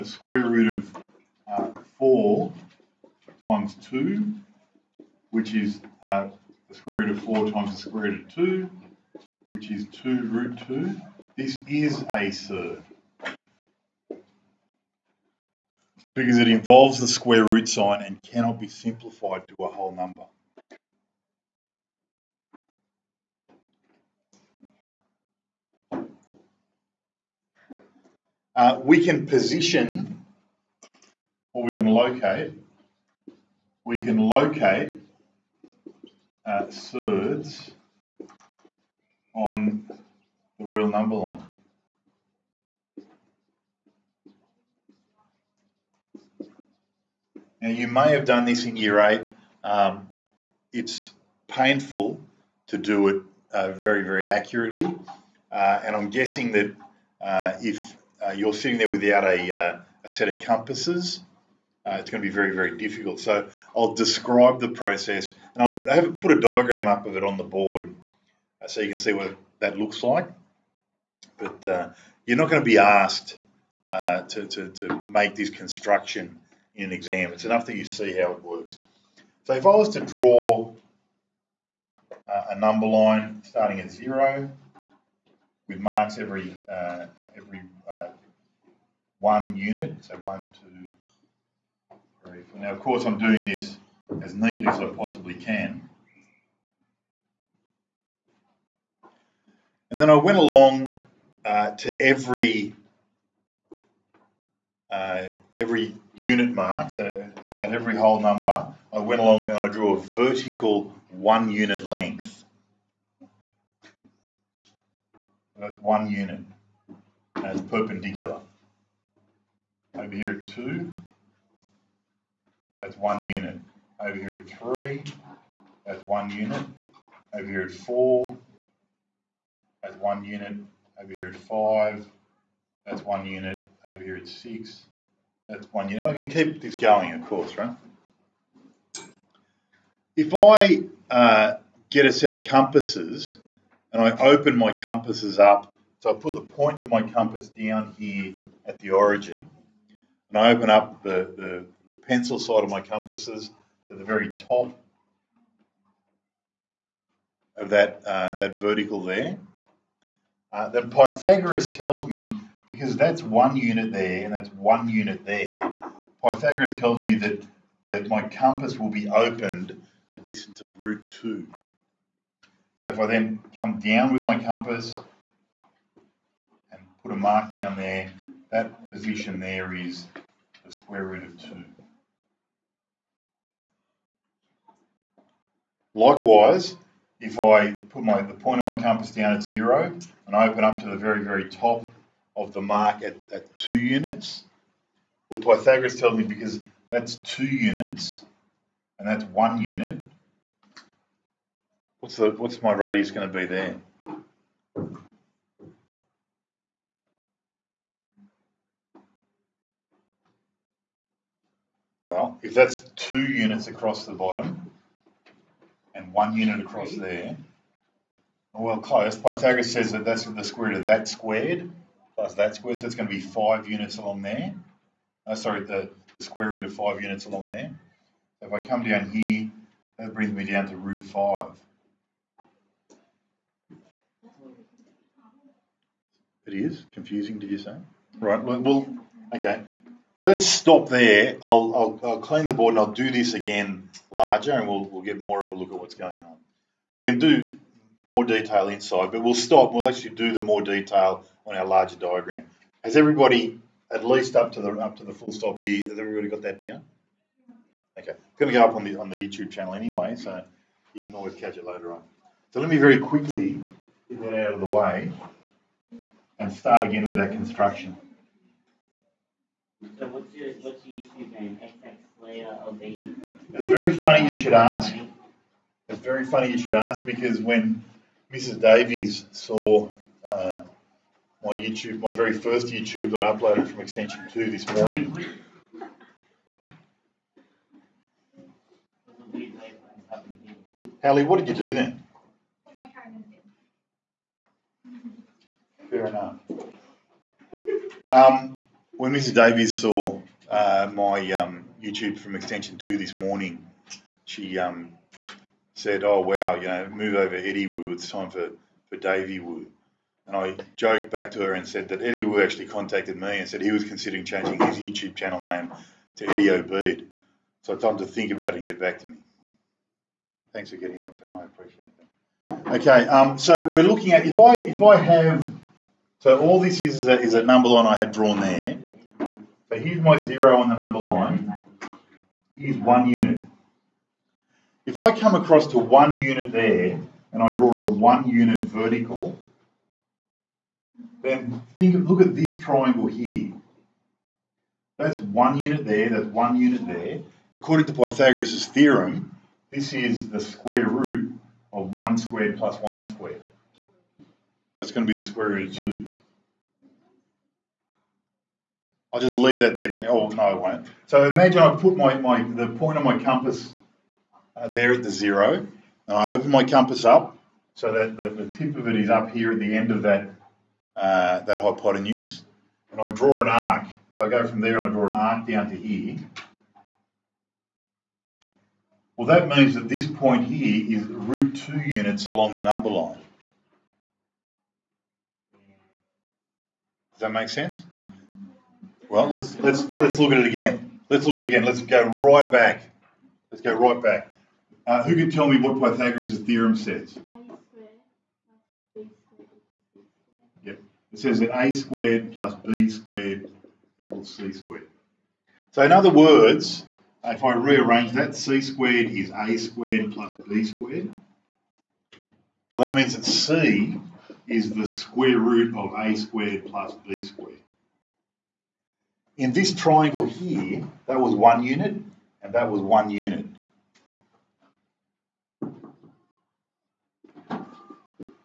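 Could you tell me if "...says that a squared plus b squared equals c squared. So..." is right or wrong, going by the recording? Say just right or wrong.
right.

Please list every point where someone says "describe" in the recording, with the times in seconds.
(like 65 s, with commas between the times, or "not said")
63 s.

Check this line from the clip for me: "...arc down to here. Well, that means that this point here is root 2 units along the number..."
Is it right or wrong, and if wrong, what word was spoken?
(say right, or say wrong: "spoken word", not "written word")
right.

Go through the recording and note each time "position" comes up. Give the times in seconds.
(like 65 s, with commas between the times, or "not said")
29 s, 178 s.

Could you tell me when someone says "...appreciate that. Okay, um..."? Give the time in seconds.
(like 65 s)
321 s.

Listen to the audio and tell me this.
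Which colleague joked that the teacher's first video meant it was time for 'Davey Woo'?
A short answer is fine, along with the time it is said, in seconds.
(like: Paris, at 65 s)
Mrs. Davies, at 278 s.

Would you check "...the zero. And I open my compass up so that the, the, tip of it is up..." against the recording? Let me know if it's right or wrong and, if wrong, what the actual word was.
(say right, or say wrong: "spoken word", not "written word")
right.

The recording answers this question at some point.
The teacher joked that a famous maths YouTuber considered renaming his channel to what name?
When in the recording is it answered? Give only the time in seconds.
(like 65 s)
316 s.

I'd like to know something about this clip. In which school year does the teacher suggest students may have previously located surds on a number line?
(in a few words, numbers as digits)
year 8.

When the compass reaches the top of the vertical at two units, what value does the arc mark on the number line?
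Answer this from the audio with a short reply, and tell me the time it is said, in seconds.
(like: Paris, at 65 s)
root 5, at 230 s.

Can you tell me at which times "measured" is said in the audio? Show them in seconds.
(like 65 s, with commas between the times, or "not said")
not said.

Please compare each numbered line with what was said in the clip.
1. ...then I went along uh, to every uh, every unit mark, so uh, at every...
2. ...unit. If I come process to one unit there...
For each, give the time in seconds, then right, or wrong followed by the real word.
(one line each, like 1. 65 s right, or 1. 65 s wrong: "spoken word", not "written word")
1. 100 s right
2. 333 s wrong: "across", not "process".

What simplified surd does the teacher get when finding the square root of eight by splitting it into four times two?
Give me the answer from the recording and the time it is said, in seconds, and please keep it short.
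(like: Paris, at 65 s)
2 root 2, at 9 s.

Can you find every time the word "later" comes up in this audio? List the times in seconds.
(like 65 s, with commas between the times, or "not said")
261 s.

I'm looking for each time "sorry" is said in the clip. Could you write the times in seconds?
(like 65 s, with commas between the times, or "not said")
225 s.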